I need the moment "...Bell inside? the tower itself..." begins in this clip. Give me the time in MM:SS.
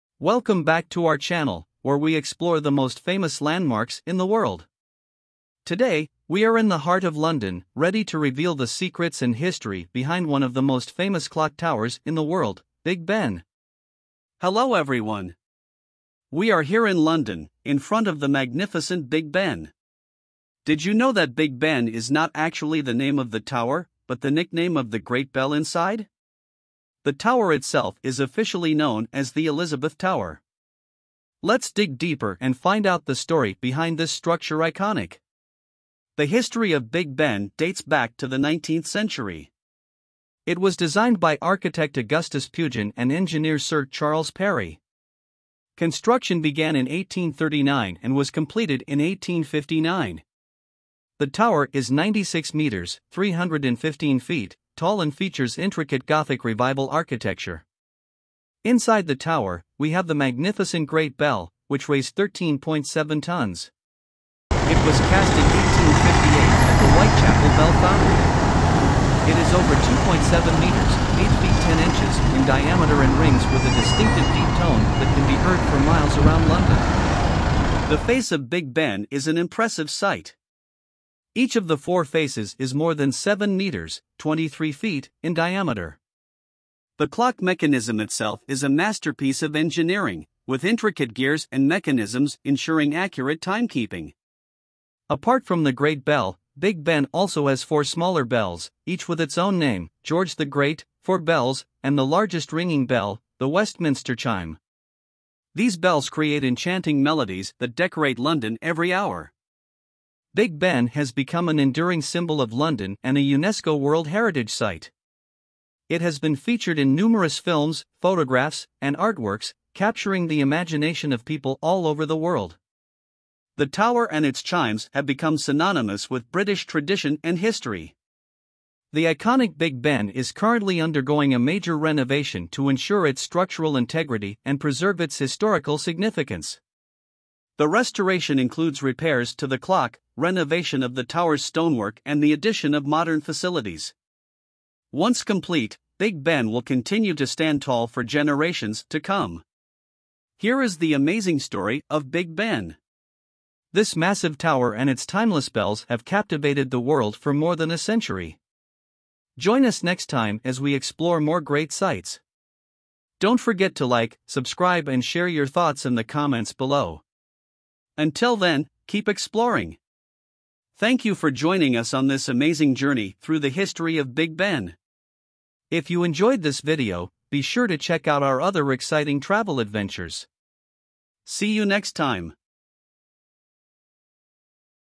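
00:25.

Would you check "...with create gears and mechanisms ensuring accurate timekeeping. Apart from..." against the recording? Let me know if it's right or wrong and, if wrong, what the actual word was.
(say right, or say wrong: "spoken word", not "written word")
wrong: "intricate", not "create".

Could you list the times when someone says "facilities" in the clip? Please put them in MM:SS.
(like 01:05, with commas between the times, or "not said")
02:23.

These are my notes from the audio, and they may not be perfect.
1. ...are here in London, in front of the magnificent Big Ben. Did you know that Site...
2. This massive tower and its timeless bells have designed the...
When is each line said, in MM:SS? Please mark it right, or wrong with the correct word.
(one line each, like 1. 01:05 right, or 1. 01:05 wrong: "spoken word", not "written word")
1. 00:16 wrong: "Big", not "Site"
2. 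02:33 wrong: "captivated", not "designed".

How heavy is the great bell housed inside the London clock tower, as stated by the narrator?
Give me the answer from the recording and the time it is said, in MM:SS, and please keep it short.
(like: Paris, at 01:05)
13.7 tons, at 01:02.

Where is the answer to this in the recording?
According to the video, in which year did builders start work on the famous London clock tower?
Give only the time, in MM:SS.
00:46.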